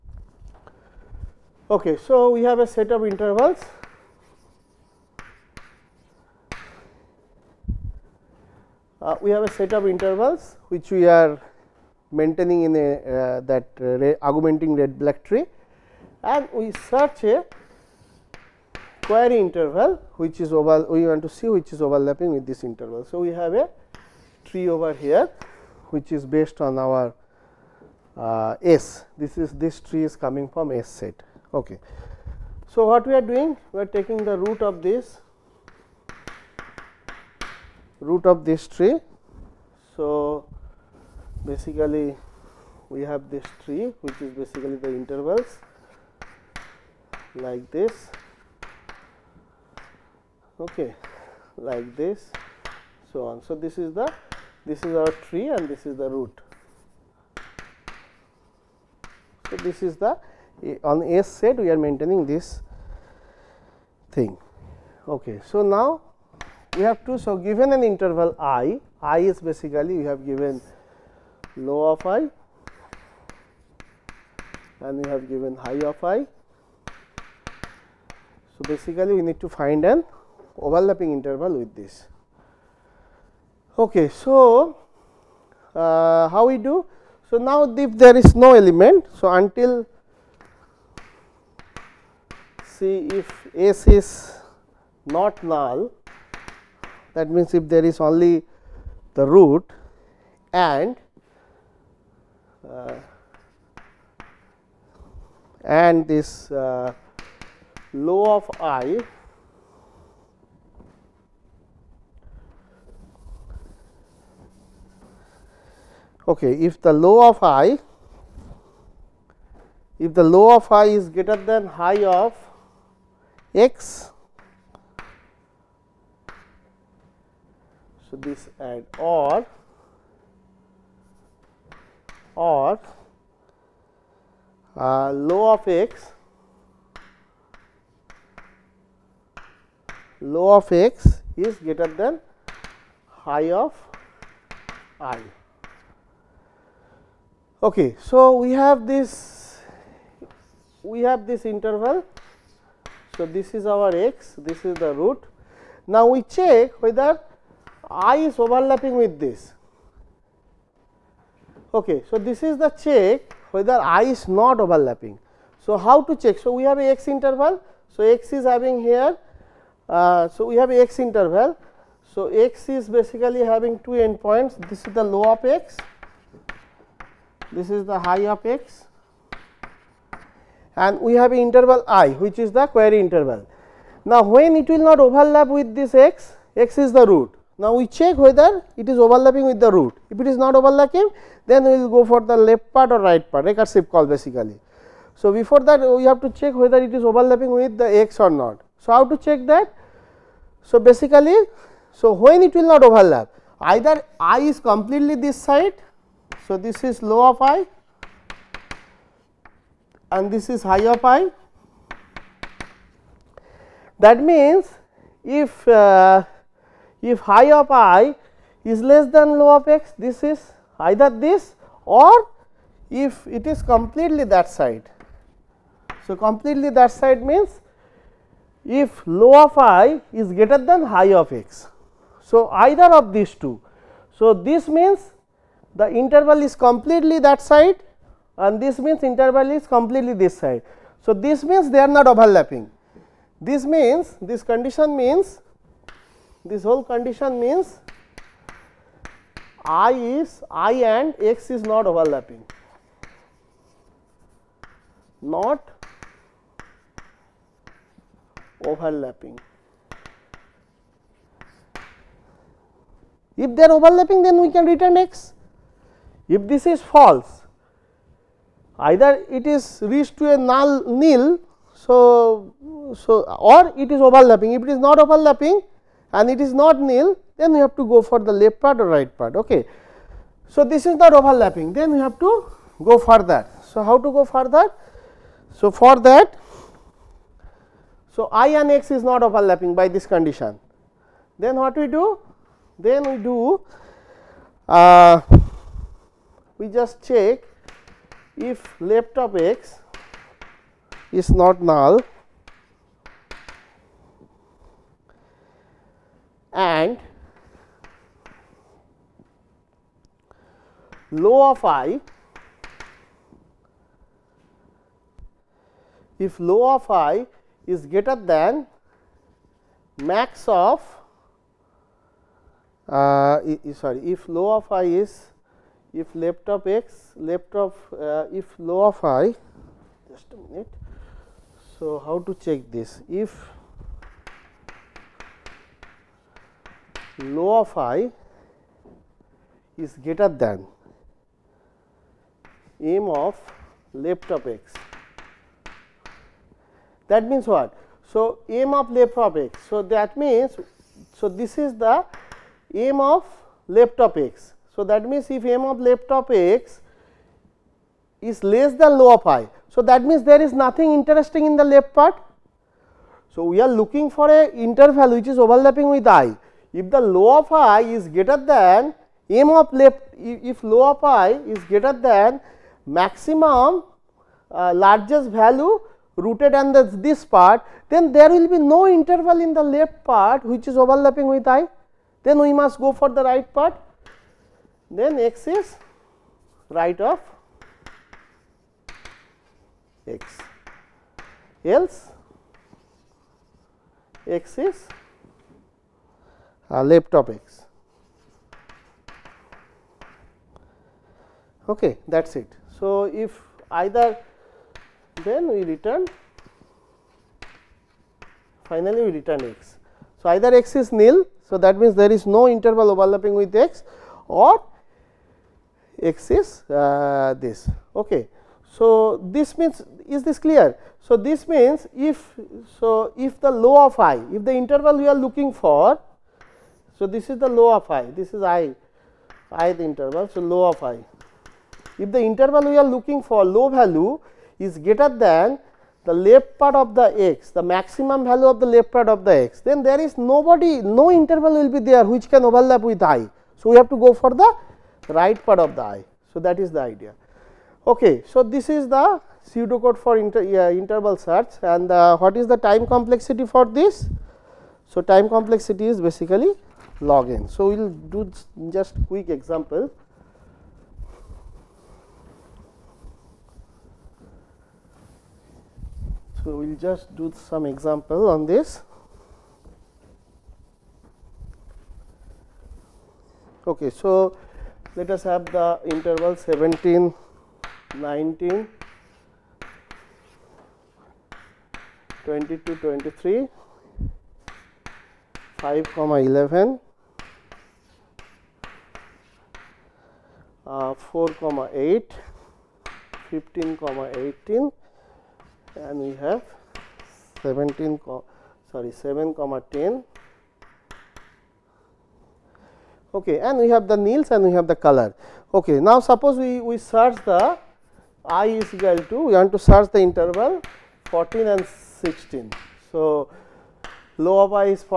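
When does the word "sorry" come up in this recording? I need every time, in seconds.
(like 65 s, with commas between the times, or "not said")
323 s, 498 s.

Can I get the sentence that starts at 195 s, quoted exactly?
So, before that we have to check whether it is overlapping with the x or not.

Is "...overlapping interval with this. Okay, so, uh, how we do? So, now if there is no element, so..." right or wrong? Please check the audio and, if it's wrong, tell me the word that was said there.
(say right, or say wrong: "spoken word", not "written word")
right.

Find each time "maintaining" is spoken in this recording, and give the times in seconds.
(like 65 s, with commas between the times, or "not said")
12 s, 61 s.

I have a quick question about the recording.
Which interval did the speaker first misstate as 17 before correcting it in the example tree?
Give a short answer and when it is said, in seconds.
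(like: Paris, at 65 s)
7 comma 10, at 498 s.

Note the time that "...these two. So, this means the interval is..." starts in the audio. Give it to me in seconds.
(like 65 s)
233 s.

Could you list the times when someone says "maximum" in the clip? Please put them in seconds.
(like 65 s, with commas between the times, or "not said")
372 s, 437 s.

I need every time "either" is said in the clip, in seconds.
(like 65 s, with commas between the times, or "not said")
203 s, 220 s, 232 s, 268 s, 403 s, 410 s.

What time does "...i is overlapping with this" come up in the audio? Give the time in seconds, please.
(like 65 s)
157 s.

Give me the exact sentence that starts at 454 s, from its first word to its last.
So, time complexity is basically log n.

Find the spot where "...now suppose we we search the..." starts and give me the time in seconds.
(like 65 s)
505 s.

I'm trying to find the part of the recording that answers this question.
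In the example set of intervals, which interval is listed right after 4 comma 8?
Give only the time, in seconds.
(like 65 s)
493 s.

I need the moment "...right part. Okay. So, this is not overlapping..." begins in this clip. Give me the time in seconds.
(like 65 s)
278 s.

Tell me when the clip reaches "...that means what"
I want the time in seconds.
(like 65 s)
347 s.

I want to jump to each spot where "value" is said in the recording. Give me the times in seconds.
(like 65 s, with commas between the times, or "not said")
375 s, 433 s, 438 s.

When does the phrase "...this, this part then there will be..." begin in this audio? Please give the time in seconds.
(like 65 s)
376 s.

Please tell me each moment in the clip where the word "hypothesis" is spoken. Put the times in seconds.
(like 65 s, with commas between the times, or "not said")
not said.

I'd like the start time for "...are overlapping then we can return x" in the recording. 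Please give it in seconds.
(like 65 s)
263 s.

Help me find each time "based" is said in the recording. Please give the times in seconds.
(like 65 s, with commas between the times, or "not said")
26 s.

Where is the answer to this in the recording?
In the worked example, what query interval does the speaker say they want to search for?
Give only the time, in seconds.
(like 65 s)
511 s.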